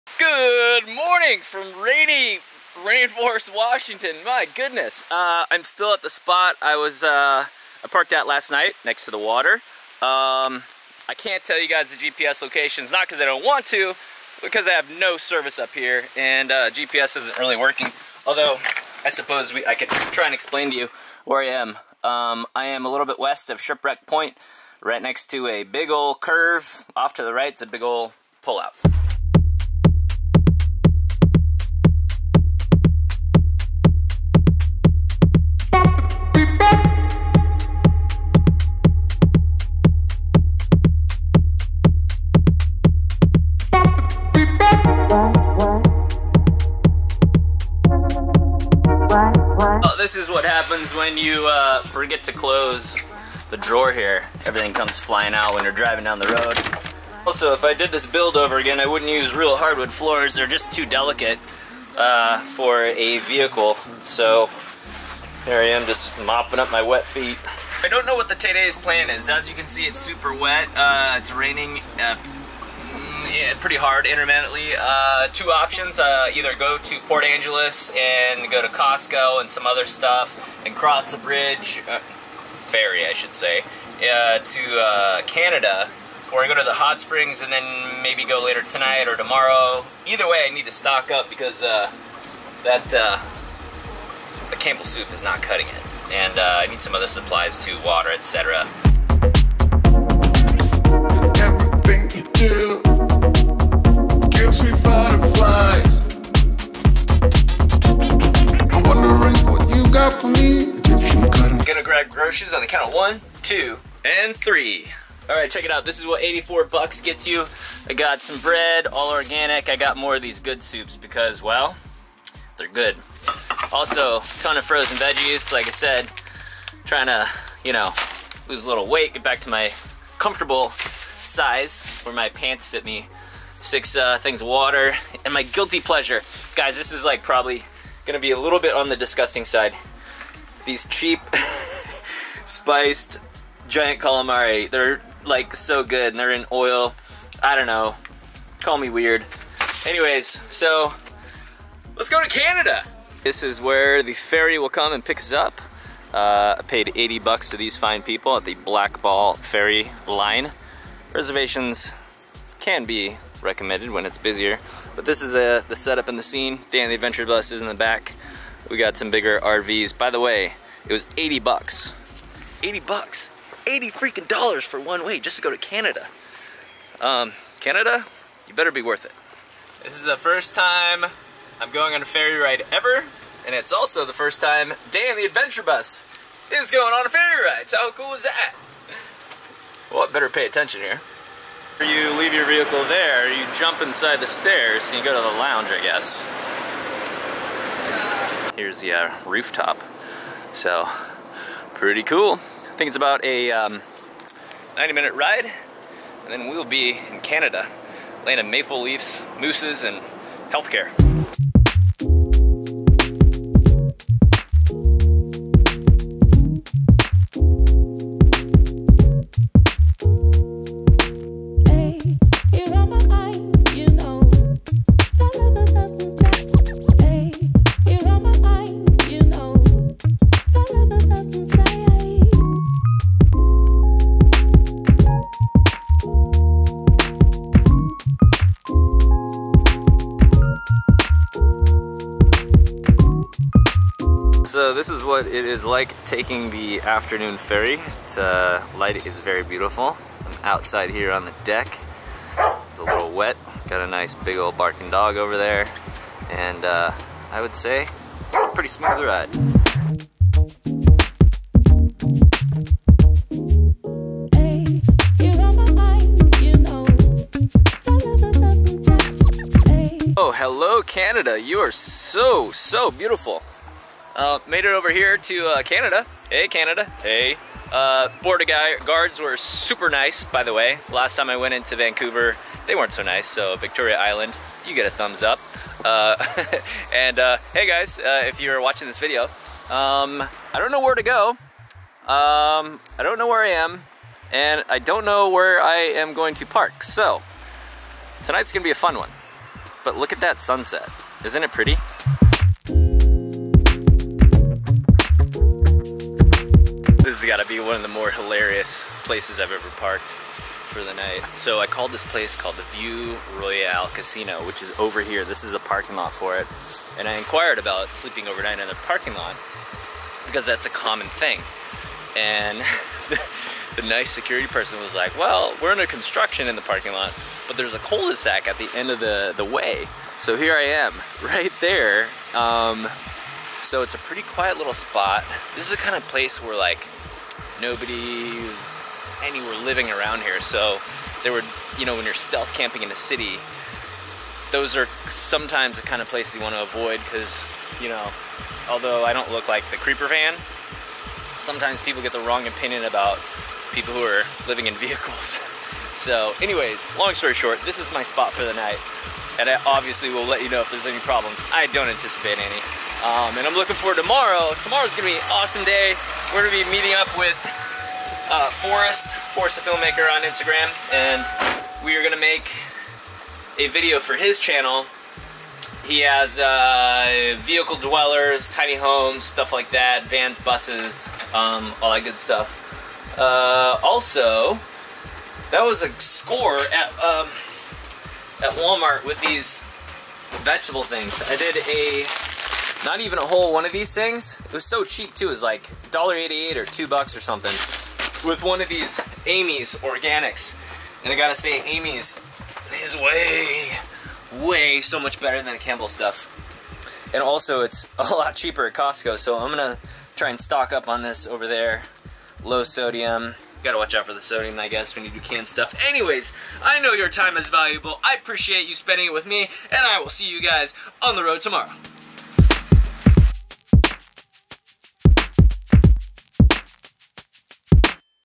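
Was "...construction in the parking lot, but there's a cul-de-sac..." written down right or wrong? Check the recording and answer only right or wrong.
right.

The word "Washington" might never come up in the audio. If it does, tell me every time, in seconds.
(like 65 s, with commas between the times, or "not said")
3 s.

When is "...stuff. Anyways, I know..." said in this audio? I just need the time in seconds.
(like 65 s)
415 s.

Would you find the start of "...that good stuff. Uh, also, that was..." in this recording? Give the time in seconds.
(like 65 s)
381 s.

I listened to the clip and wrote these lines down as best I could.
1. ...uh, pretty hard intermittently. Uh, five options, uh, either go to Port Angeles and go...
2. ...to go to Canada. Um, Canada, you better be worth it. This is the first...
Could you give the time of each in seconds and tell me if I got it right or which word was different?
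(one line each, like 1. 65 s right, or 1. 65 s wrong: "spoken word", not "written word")
1. 72 s wrong: "two", not "five"
2. 175 s right.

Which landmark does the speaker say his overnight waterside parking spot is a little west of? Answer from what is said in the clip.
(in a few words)
Shipwreck Point.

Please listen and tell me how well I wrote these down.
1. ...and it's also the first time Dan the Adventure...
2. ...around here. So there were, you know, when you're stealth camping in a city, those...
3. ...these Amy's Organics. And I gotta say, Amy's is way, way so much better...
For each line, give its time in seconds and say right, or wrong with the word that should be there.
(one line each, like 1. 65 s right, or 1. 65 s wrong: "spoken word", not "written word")
1. 183 s right
2. 339 s right
3. 398 s right.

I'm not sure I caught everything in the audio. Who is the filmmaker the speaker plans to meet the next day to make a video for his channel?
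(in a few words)
Forrest.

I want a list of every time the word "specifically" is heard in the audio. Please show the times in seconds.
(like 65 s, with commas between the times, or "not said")
not said.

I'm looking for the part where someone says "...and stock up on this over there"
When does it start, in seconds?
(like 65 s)
410 s.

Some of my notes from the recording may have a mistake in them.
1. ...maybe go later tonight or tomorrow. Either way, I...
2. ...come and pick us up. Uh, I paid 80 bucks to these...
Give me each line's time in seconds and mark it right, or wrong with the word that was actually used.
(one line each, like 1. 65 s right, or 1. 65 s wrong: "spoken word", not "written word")
1. 88 s right
2. 154 s right.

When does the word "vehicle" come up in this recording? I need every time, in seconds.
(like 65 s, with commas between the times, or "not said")
63 s, 192 s, 354 s, 377 s.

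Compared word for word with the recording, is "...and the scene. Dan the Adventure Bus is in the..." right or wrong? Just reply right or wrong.
right.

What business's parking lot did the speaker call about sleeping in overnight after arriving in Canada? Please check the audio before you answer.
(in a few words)
View Royal Casino.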